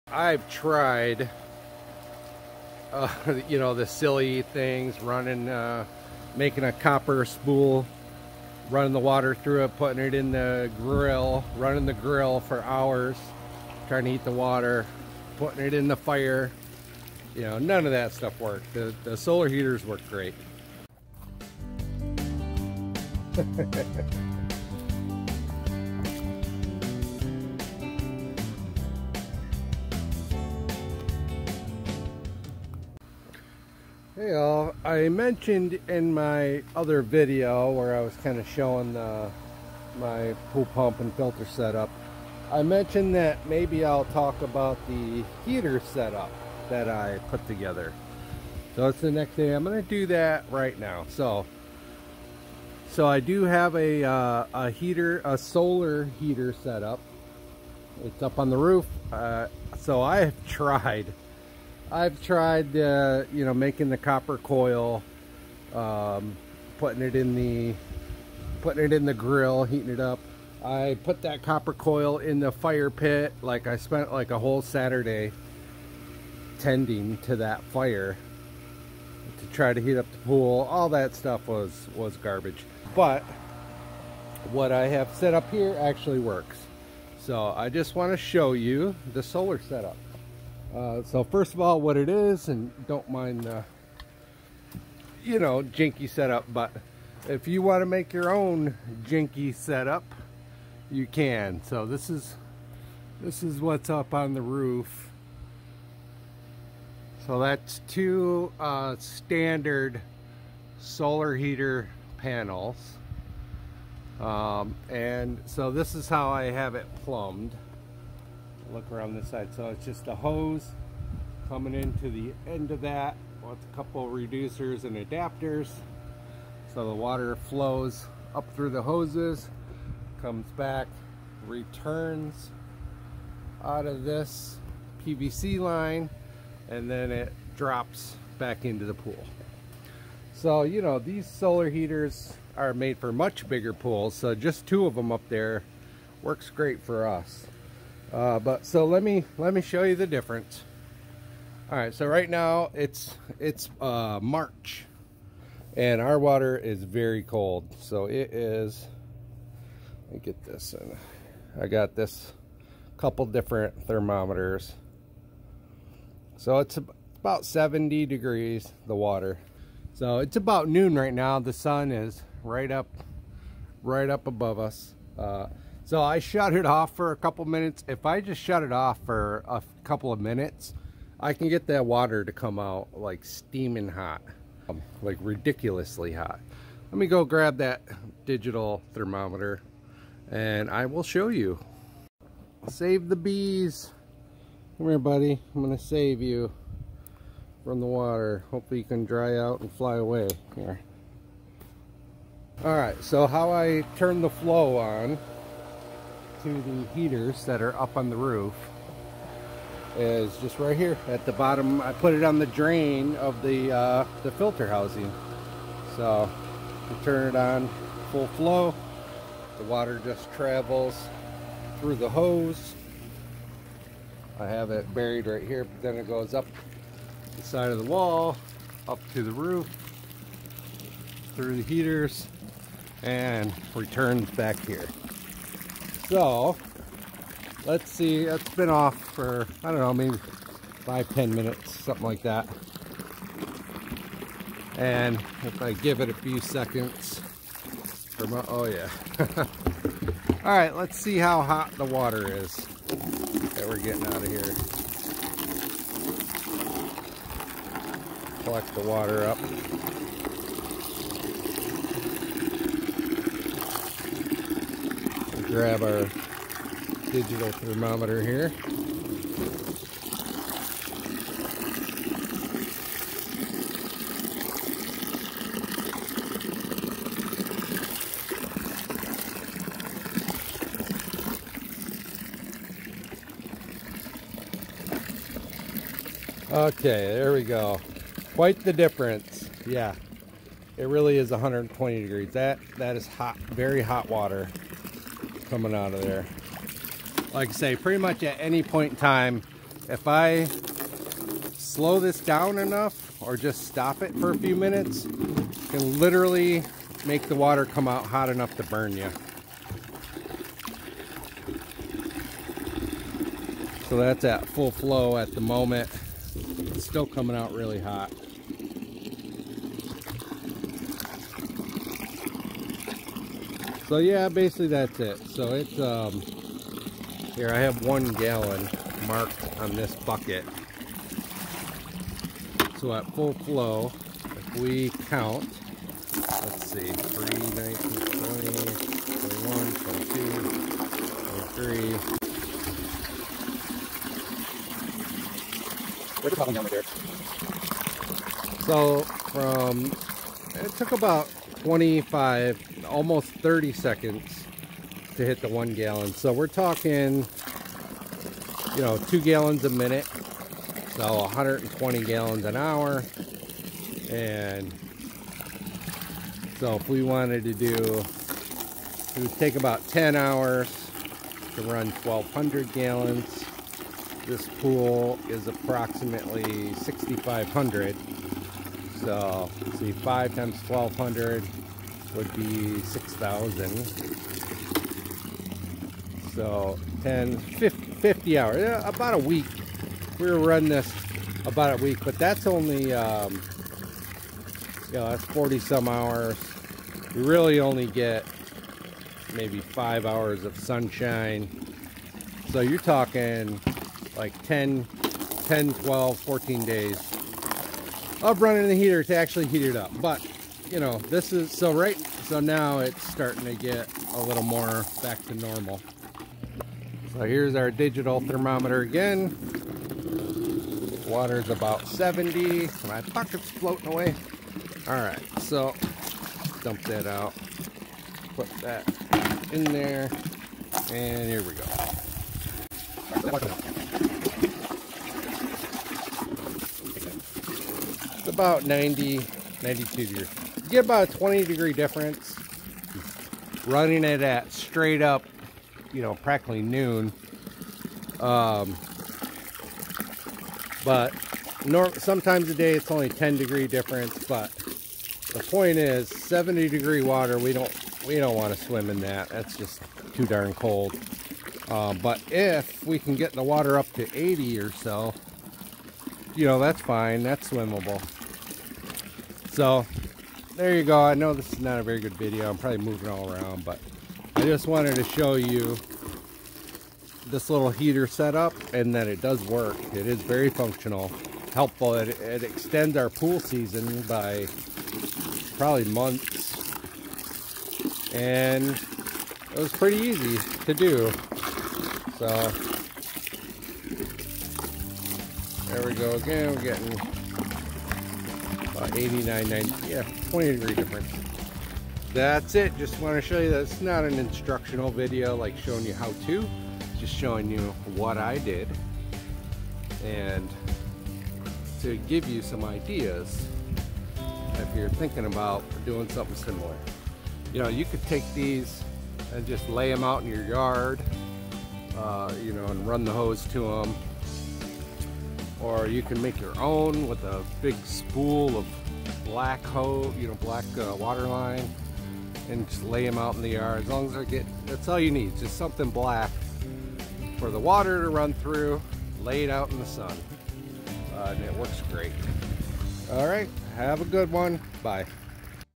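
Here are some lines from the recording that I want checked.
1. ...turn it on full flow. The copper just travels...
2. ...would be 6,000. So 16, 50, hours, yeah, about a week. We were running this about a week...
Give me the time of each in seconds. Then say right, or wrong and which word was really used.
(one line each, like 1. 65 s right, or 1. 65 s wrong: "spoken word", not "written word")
1. 217 s wrong: "water", not "copper"
2. 382 s wrong: "10", not "16".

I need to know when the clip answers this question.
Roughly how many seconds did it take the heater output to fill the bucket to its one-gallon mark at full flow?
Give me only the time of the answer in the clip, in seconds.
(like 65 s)
351 s.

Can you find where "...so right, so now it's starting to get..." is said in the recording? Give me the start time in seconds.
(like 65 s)
411 s.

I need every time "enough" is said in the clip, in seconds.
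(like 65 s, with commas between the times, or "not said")
302 s, 308 s.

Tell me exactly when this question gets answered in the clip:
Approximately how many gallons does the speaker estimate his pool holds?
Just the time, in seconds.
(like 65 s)
376 s.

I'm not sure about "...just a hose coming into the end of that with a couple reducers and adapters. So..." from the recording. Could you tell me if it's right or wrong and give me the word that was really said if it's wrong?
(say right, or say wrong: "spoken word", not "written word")
right.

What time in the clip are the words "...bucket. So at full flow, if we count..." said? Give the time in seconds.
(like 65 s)
329 s.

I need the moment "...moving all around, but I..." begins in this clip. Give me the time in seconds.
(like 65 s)
472 s.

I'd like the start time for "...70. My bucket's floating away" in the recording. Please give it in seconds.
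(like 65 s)
421 s.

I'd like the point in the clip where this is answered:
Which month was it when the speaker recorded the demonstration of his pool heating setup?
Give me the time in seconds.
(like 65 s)
154 s.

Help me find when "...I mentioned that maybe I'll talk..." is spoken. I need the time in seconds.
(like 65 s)
42 s.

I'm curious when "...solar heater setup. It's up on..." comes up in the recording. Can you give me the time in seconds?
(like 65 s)
55 s.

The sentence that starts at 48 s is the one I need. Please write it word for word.
So it's the next thing I'm going to do that right now.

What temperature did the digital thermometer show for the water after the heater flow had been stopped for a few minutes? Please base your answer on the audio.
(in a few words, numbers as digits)
120 degrees.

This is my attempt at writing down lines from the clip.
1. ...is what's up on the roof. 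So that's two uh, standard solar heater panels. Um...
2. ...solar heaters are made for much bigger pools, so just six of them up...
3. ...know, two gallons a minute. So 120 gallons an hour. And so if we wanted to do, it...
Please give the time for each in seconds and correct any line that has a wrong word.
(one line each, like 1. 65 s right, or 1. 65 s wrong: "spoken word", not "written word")
1. 103 s right
2. 141 s wrong: "two", not "six"
3. 358 s right.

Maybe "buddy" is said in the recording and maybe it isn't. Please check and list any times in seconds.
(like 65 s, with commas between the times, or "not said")
194 s.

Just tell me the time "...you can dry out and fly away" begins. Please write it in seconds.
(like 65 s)
198 s.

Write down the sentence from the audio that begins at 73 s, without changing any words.
Like I spent like a whole Saturday tending to that fire to try to heat up the pool.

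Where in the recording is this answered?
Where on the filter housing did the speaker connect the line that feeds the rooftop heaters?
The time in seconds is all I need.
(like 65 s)
212 s.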